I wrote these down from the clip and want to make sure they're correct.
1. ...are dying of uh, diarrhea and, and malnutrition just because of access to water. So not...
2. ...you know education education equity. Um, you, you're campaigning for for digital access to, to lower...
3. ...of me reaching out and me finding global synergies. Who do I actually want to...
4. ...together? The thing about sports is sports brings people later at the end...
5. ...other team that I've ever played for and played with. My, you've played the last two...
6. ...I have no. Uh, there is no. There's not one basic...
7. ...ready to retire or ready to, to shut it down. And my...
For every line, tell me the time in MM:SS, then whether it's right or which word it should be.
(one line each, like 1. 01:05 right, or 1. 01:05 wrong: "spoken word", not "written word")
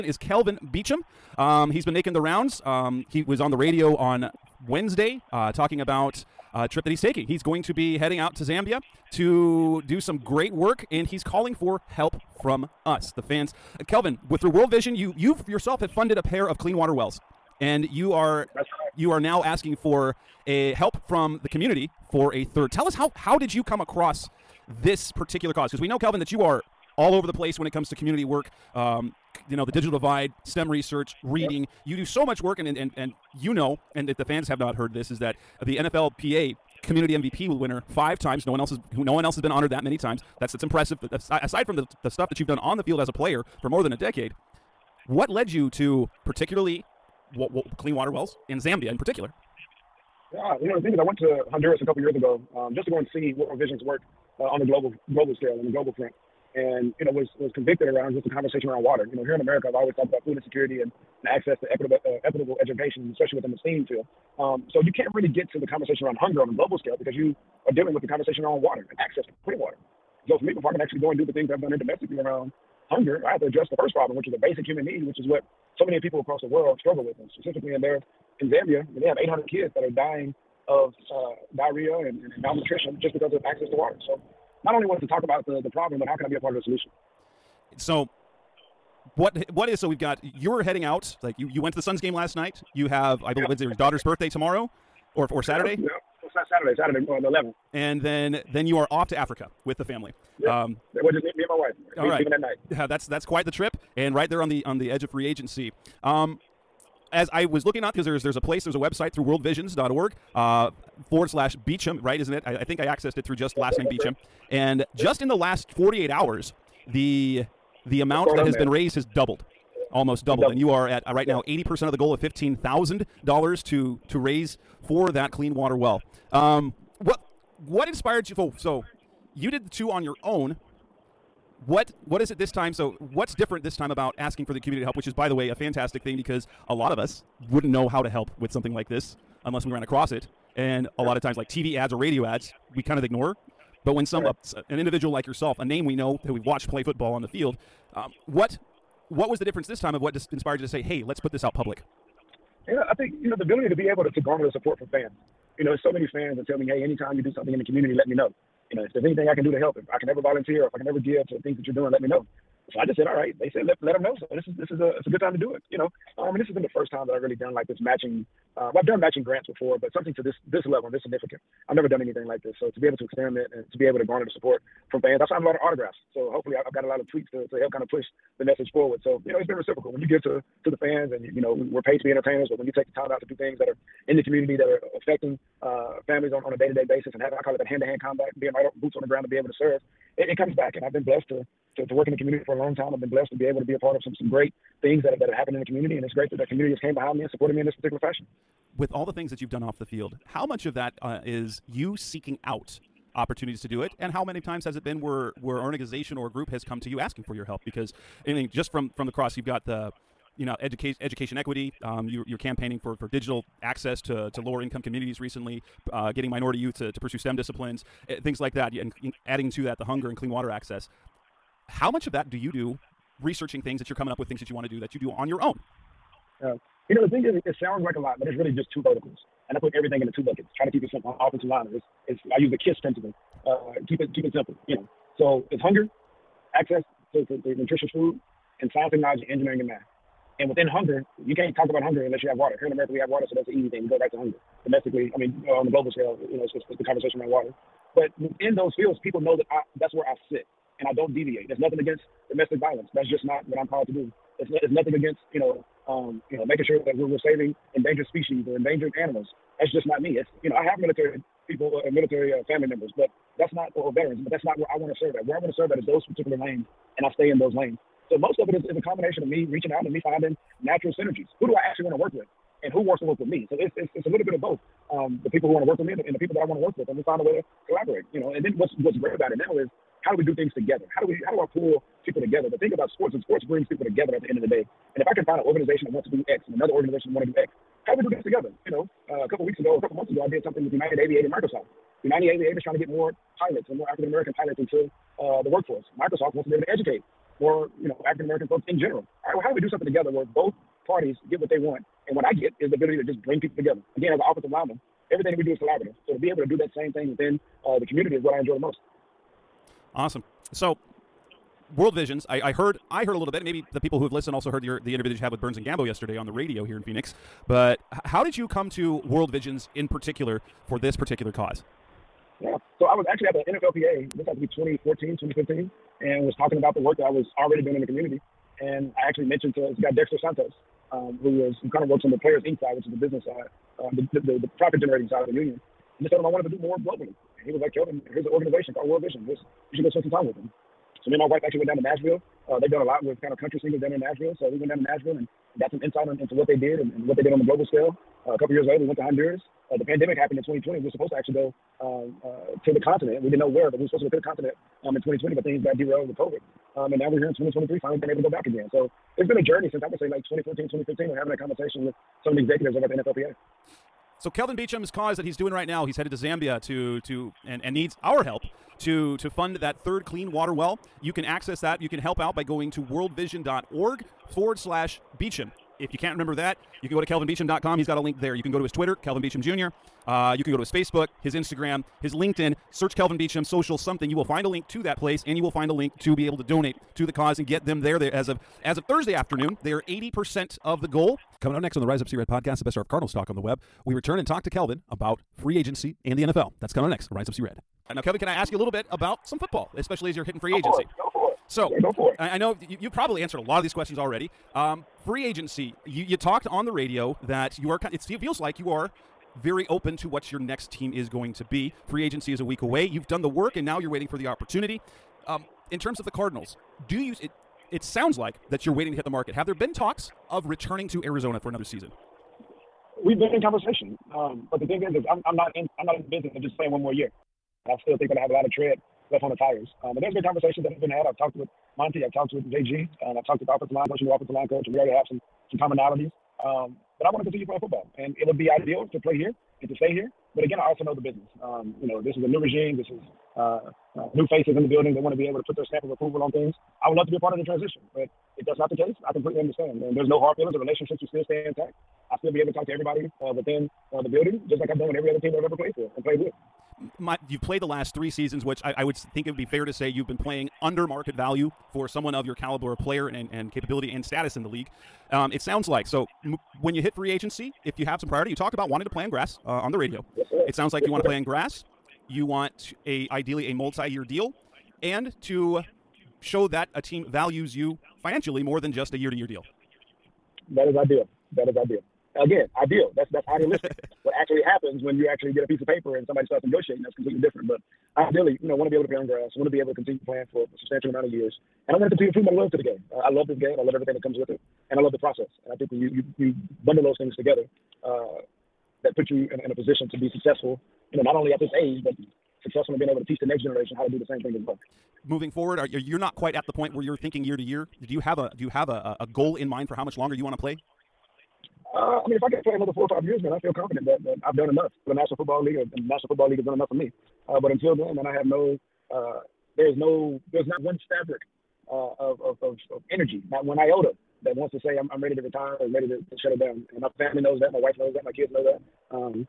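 1. 01:19 right
2. 03:30 right
3. 04:29 wrong: "natural", not "global"
4. 04:42 wrong: "together", not "later"
5. 07:35 wrong: "three", not "two"
6. 08:38 wrong: "fabric", not "basic"
7. 08:45 right.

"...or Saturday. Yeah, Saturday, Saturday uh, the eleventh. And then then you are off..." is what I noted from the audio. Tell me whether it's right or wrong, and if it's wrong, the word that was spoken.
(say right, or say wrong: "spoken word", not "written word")
right.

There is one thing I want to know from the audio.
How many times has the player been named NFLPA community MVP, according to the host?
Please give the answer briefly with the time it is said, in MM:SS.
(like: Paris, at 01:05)
5, at 00:37.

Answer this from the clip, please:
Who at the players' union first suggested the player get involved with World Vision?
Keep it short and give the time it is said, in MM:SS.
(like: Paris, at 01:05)
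Dexter Santos, at 05:29.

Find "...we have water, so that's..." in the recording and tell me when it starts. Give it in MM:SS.
04:02.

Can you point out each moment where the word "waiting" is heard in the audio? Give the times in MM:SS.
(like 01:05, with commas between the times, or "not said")
06:53, 06:58.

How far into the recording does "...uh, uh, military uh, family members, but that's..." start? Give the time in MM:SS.
04:21.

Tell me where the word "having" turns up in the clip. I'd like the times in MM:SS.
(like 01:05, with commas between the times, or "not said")
03:07, 06:01.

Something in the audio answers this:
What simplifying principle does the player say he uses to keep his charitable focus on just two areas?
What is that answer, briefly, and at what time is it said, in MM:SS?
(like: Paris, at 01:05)
KISS principle, at 03:52.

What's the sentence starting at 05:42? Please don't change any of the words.
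Uh, they've done a lot with kind of country singers down in Nashville.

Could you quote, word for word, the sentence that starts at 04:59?
All right, well, how do we do something together where both parties get what they want?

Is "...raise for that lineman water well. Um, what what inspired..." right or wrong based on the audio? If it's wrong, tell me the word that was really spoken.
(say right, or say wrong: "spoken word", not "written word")
wrong: "clean", not "lineman".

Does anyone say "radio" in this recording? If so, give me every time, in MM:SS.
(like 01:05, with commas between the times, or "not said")
00:03, 02:21, 05:16, 06:46, 07:49.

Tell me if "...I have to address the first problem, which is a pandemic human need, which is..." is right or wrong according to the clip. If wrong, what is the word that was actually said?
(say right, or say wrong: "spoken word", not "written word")
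wrong: "basic", not "pandemic".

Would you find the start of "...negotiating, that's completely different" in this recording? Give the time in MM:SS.
08:06.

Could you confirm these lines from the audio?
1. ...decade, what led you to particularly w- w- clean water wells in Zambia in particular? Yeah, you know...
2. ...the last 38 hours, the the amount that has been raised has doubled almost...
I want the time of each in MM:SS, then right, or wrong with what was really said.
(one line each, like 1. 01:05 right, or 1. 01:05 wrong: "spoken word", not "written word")
1. 00:43 right
2. 01:55 wrong: "48", not "38".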